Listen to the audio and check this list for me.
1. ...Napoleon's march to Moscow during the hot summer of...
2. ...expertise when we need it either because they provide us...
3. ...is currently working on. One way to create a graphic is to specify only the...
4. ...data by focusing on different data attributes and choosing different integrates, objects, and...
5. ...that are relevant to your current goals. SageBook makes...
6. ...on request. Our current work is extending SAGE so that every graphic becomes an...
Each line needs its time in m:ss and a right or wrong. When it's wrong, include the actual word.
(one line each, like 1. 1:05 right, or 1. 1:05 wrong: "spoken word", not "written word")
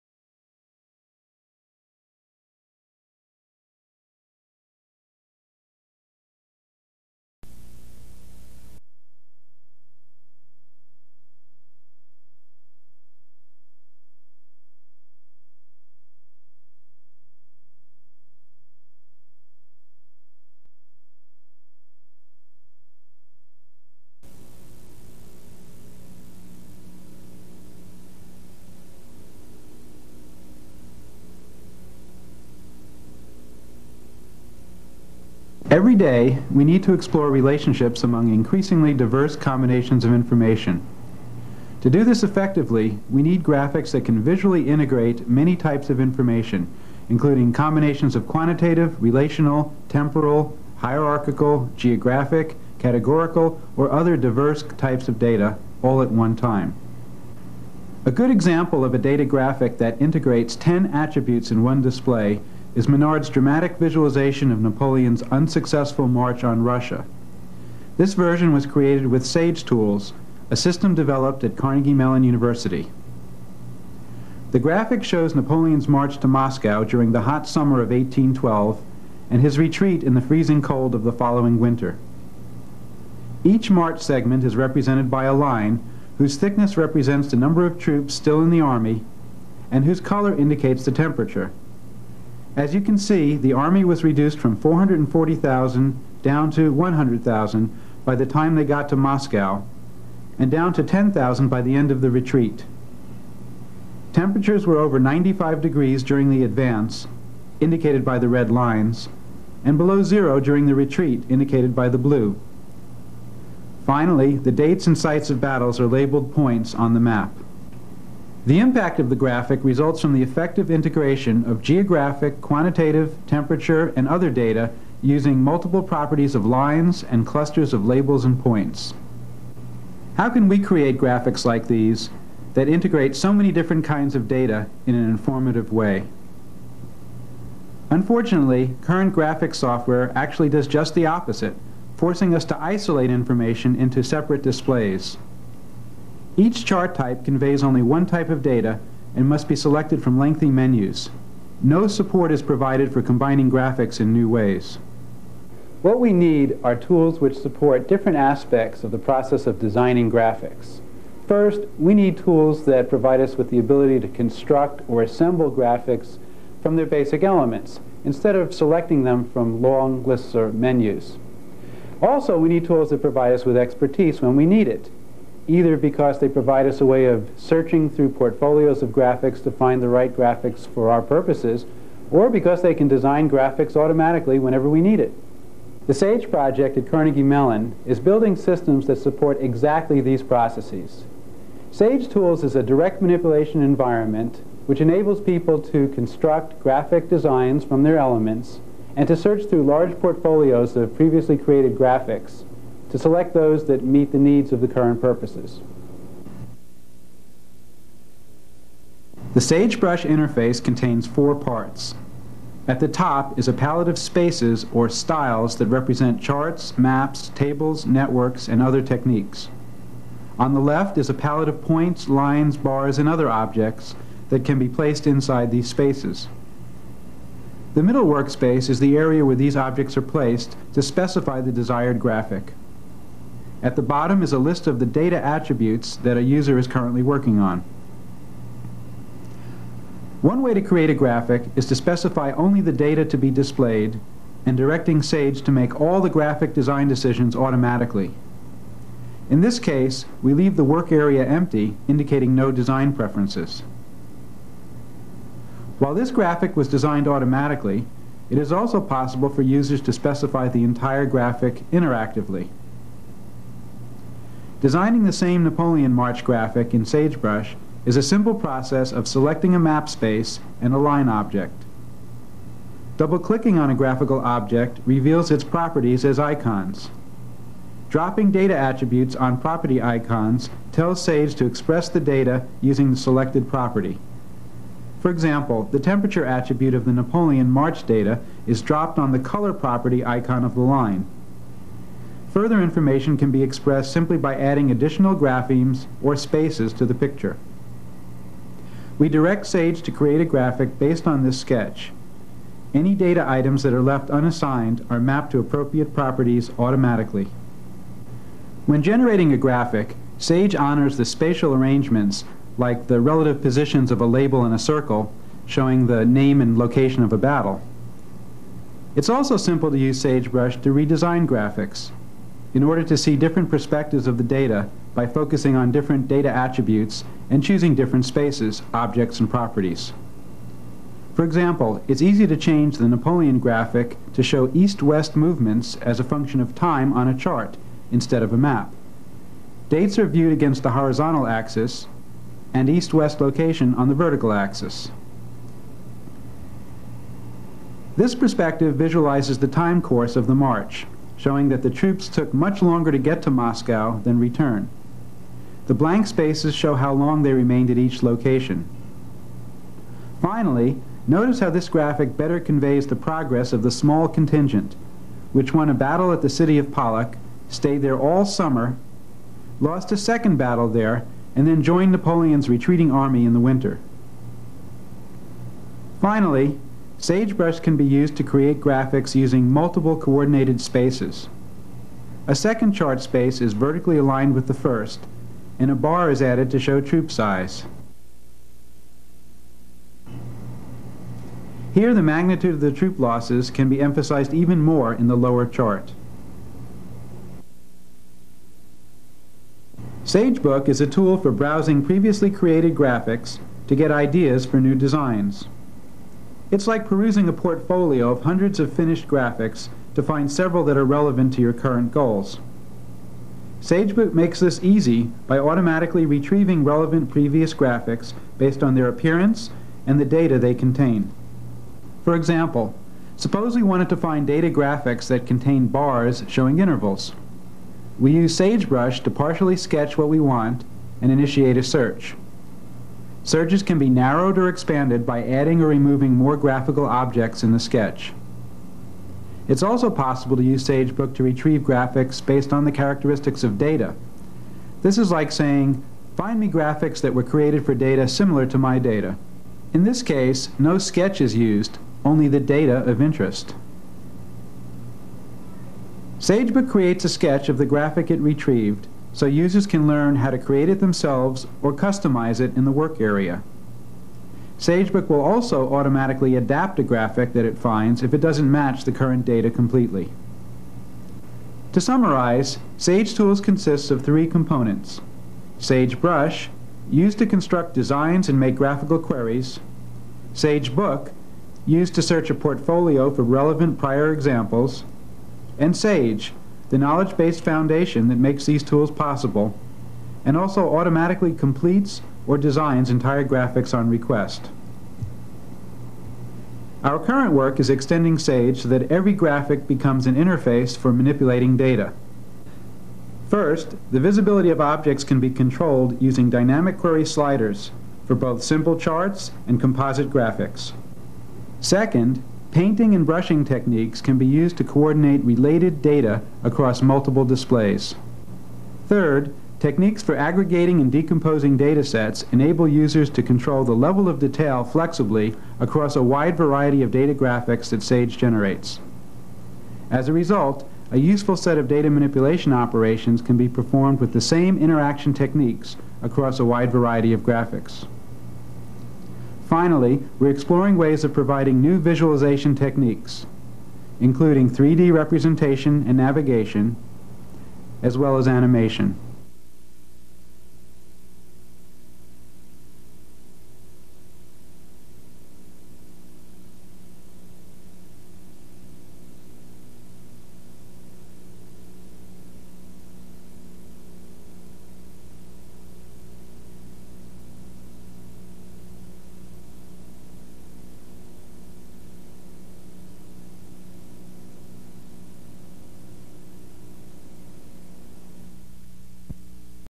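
1. 1:15 right
2. 2:53 right
3. 3:56 right
4. 5:24 wrong: "spaces", not "integrates"
5. 6:50 right
6. 8:13 right.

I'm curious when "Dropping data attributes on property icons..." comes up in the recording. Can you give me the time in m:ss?
4:37.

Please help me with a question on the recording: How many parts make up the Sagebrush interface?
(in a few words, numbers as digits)
4.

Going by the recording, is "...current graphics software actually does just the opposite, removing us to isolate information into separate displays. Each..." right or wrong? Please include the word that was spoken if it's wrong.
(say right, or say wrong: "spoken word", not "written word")
wrong: "forcing", not "removing".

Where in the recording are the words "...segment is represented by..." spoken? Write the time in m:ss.
1:24.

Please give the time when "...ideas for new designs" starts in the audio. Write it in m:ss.
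6:43.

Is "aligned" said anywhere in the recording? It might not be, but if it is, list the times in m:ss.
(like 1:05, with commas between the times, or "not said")
6:23.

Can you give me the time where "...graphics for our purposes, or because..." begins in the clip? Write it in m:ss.
3:00.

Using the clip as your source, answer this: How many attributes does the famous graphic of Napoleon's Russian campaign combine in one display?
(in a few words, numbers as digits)
10.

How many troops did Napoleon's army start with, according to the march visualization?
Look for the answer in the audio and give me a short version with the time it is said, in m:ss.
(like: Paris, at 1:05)
440,000, at 1:34.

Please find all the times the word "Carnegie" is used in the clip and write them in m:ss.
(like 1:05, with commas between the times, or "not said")
1:11, 3:06.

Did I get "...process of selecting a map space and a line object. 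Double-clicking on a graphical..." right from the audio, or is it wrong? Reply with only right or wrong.
right.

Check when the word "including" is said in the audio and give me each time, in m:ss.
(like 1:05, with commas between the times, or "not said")
0:47, 9:03.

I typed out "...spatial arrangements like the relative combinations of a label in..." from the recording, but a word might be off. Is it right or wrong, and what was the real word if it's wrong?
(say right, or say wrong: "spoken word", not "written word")
wrong: "positions", not "combinations".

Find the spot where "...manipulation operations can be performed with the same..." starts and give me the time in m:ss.
8:51.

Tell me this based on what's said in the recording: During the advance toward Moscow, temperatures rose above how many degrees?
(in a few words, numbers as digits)
95.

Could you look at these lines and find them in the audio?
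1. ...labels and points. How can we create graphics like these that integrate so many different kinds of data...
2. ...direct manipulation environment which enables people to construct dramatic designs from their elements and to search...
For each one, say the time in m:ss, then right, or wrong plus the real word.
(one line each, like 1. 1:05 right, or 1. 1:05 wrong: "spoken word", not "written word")
1. 2:07 right
2. 3:12 wrong: "graphic", not "dramatic".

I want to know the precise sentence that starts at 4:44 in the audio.
For example, the temperature attribute of the Napoleon March data is dropped on the color property icon of the line.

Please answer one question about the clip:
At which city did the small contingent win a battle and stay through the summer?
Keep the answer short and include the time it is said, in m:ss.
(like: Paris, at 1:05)
Pollock, at 6:06.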